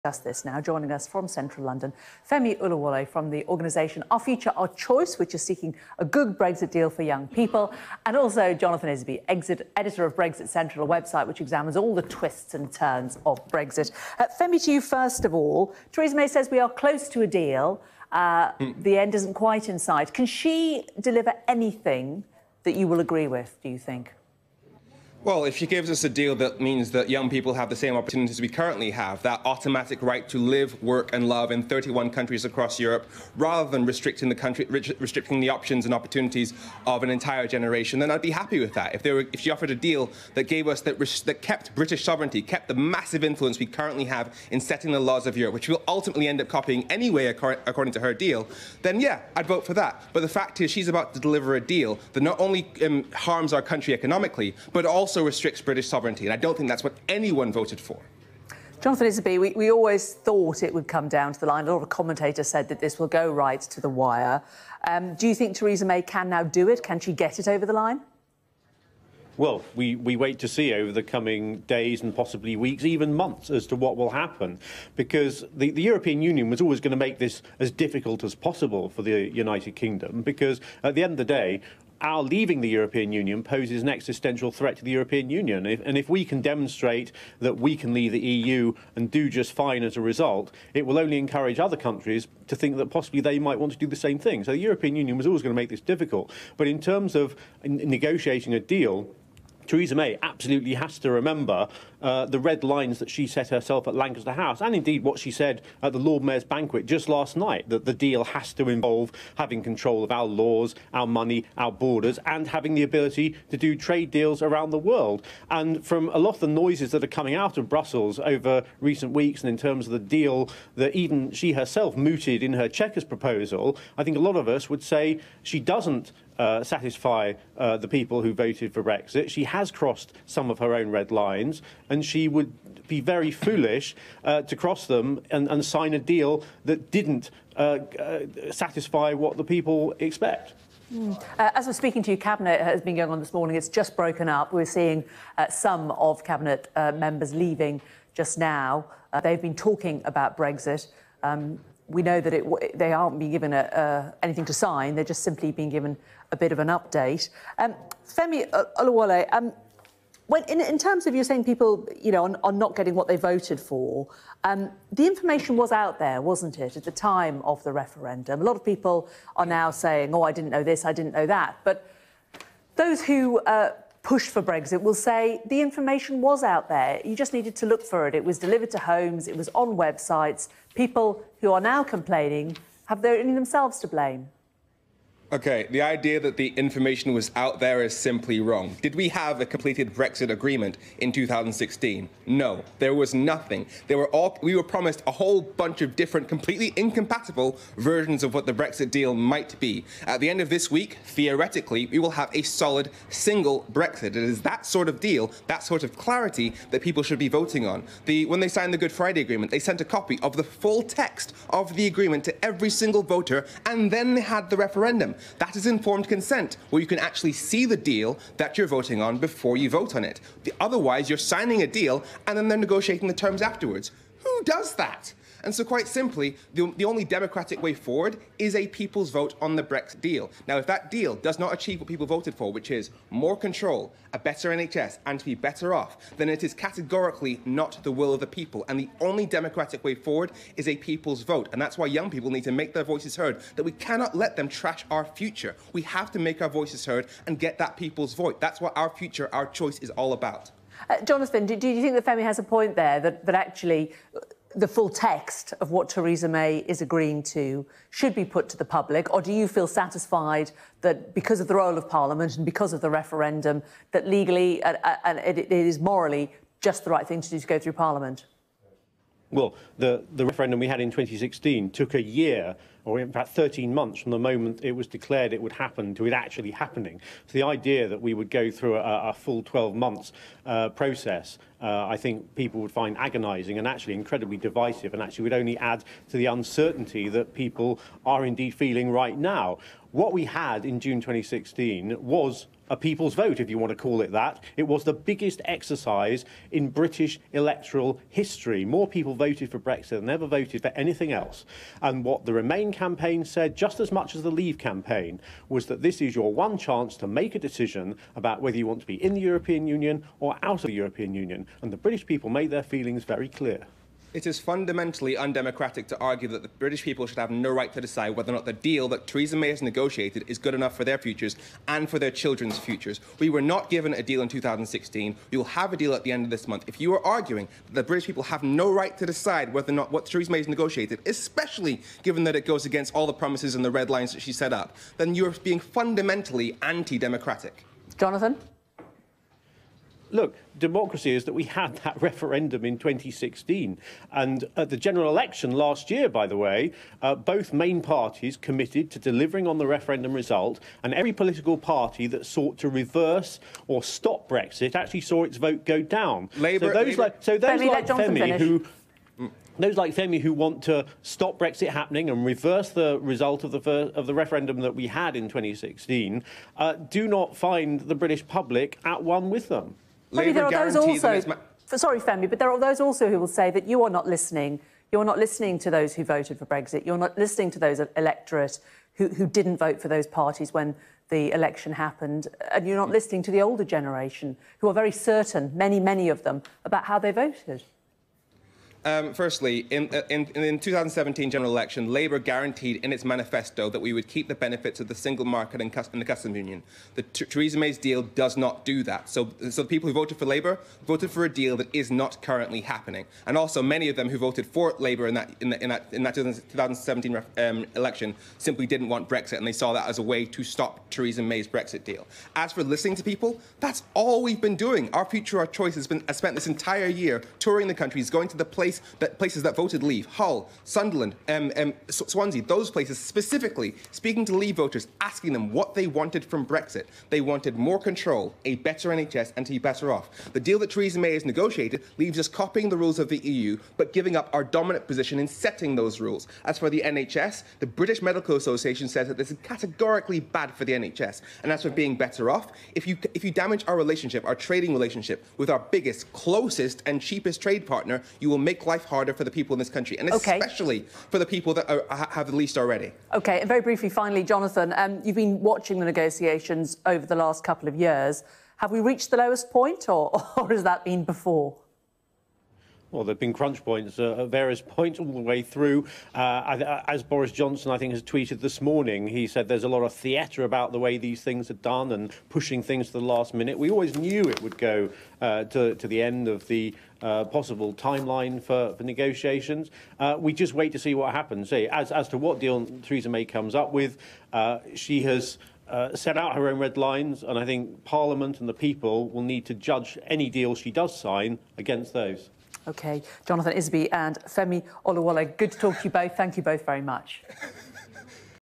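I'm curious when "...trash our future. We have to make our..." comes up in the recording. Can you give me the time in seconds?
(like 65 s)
244 s.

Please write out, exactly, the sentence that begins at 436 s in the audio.
As for the NHS, the British Medical Association says that this is categorically bad for the NHS.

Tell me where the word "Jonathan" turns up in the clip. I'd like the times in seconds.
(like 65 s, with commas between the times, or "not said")
8 s, 58 s, 251 s, 337 s, 454 s, 493 s.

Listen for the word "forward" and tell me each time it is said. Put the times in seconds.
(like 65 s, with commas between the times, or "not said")
227 s, 239 s.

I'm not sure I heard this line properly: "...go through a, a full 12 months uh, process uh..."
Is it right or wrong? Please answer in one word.
right.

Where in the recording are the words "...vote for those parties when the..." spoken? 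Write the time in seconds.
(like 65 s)
379 s.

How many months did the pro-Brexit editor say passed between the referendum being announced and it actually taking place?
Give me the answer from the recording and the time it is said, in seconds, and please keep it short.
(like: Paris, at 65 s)
13 months, at 273 s.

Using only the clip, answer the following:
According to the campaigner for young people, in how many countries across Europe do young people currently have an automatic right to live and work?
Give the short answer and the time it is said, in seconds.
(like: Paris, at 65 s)
31, at 31 s.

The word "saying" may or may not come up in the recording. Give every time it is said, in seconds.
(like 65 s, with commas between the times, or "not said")
161 s, 169 s.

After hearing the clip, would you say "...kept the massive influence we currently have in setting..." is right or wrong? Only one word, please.
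right.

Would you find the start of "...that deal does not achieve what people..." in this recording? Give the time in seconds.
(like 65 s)
230 s.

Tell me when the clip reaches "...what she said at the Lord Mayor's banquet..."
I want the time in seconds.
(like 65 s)
105 s.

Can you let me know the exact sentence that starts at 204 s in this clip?
It is that sort of deal, that sort of clarity that people should be voting on.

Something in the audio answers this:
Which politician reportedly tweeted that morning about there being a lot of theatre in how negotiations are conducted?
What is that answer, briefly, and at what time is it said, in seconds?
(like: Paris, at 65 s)
Boris Johnson, at 467 s.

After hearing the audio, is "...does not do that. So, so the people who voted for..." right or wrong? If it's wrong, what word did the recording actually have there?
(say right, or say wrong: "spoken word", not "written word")
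right.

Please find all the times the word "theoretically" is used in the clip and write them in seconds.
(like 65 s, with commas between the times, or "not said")
201 s.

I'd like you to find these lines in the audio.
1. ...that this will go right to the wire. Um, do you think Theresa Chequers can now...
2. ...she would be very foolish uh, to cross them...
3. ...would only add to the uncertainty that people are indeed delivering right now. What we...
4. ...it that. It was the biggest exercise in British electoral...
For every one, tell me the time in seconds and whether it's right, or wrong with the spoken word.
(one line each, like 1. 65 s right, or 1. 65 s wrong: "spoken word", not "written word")
1. 62 s wrong: "May", not "Chequers"
2. 132 s right
3. 285 s wrong: "feeling", not "delivering"
4. 294 s right.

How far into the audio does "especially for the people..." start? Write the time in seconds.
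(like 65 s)
450 s.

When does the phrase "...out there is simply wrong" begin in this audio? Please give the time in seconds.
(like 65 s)
187 s.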